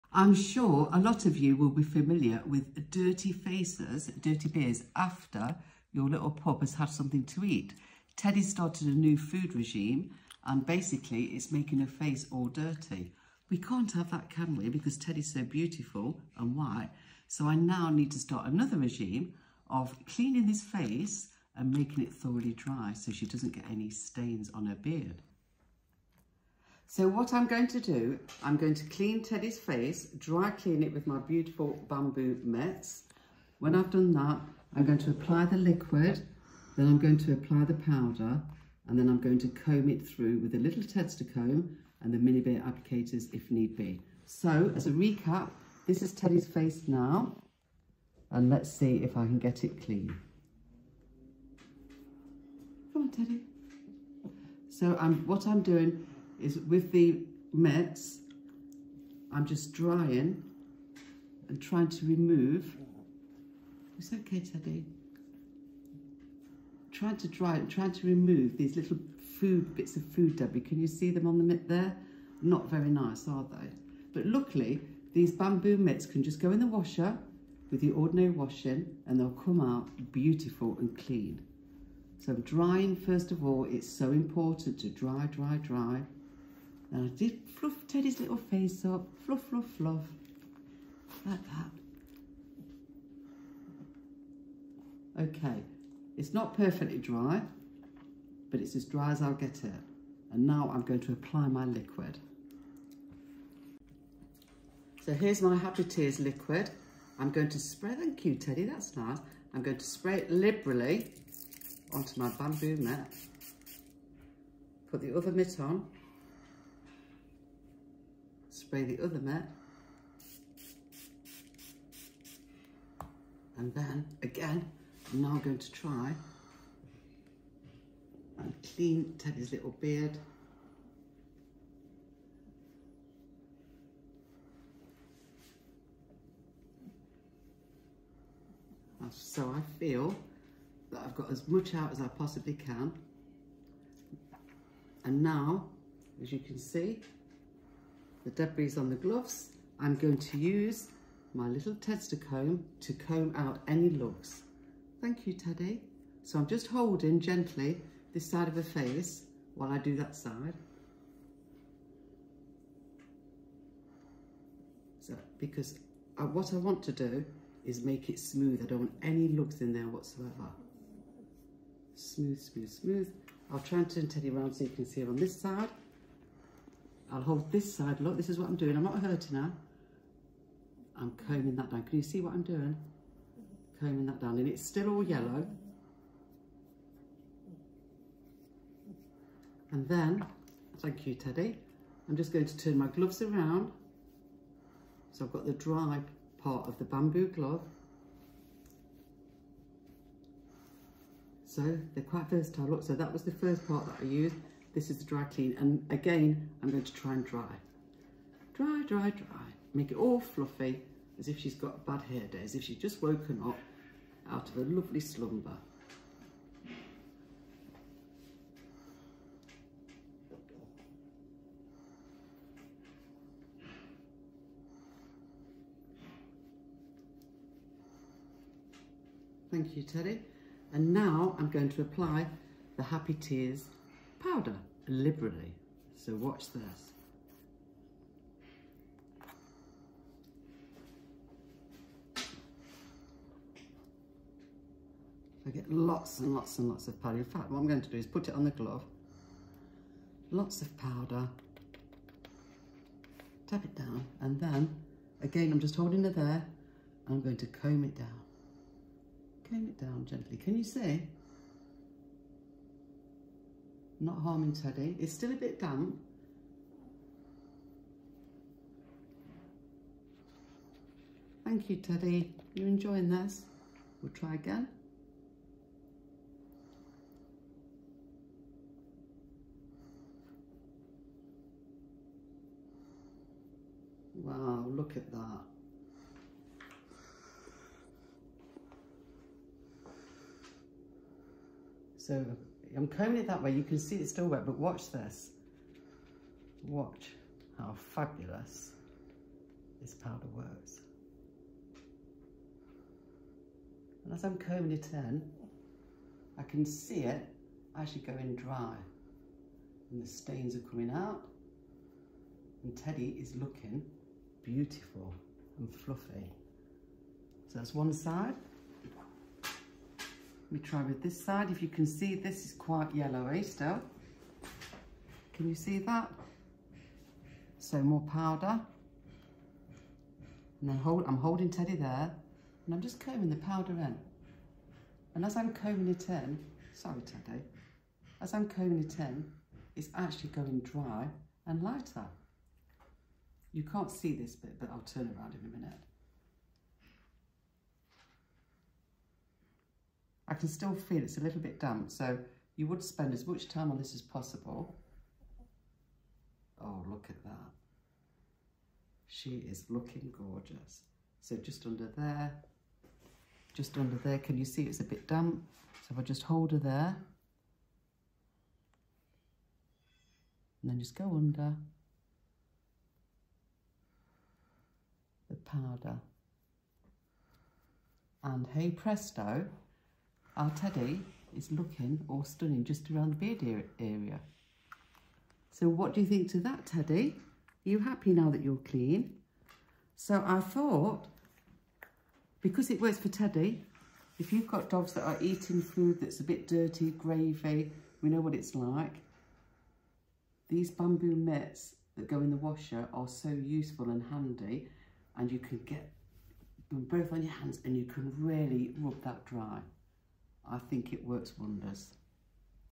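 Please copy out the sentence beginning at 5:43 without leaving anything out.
You can't see this bit, but I'll turn around in a minute.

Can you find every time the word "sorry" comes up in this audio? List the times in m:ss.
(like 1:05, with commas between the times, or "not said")
5:36.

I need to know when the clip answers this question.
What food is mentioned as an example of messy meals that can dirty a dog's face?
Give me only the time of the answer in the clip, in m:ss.
6:36.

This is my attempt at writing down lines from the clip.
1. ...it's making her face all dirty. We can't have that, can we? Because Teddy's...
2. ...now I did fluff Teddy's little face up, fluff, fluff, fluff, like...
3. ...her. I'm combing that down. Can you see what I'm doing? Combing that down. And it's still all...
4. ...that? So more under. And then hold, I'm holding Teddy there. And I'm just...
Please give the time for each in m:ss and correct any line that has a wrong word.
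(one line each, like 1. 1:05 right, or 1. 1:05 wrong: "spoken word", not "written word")
1. 0:11 right
2. 1:26 right
3. 2:59 right
4. 5:25 wrong: "powder", not "under".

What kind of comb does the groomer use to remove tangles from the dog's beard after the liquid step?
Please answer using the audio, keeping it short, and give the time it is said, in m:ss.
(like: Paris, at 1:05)
Tester comb, at 2:31.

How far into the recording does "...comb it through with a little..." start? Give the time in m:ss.
0:39.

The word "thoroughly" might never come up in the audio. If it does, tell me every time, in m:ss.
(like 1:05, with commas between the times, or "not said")
0:22.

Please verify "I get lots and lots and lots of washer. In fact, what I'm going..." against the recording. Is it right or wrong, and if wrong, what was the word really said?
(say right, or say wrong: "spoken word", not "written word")
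wrong: "powder", not "washer".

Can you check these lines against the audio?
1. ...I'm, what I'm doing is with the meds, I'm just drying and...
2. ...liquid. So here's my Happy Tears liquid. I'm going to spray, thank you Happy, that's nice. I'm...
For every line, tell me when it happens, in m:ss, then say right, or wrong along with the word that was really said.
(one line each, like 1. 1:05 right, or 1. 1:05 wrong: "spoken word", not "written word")
1. 0:54 right
2. 1:41 wrong: "Teddy", not "Happy".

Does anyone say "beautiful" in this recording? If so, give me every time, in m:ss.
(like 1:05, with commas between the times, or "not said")
0:15, 0:31, 1:20, 5:14.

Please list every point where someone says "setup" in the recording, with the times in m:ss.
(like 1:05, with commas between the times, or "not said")
not said.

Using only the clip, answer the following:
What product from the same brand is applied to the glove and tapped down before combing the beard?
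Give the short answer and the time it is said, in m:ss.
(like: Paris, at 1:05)
Happy Tears powder, at 3:52.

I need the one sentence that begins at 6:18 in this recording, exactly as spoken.
And hey presto, our teddy is looking all stunning just around the beard area.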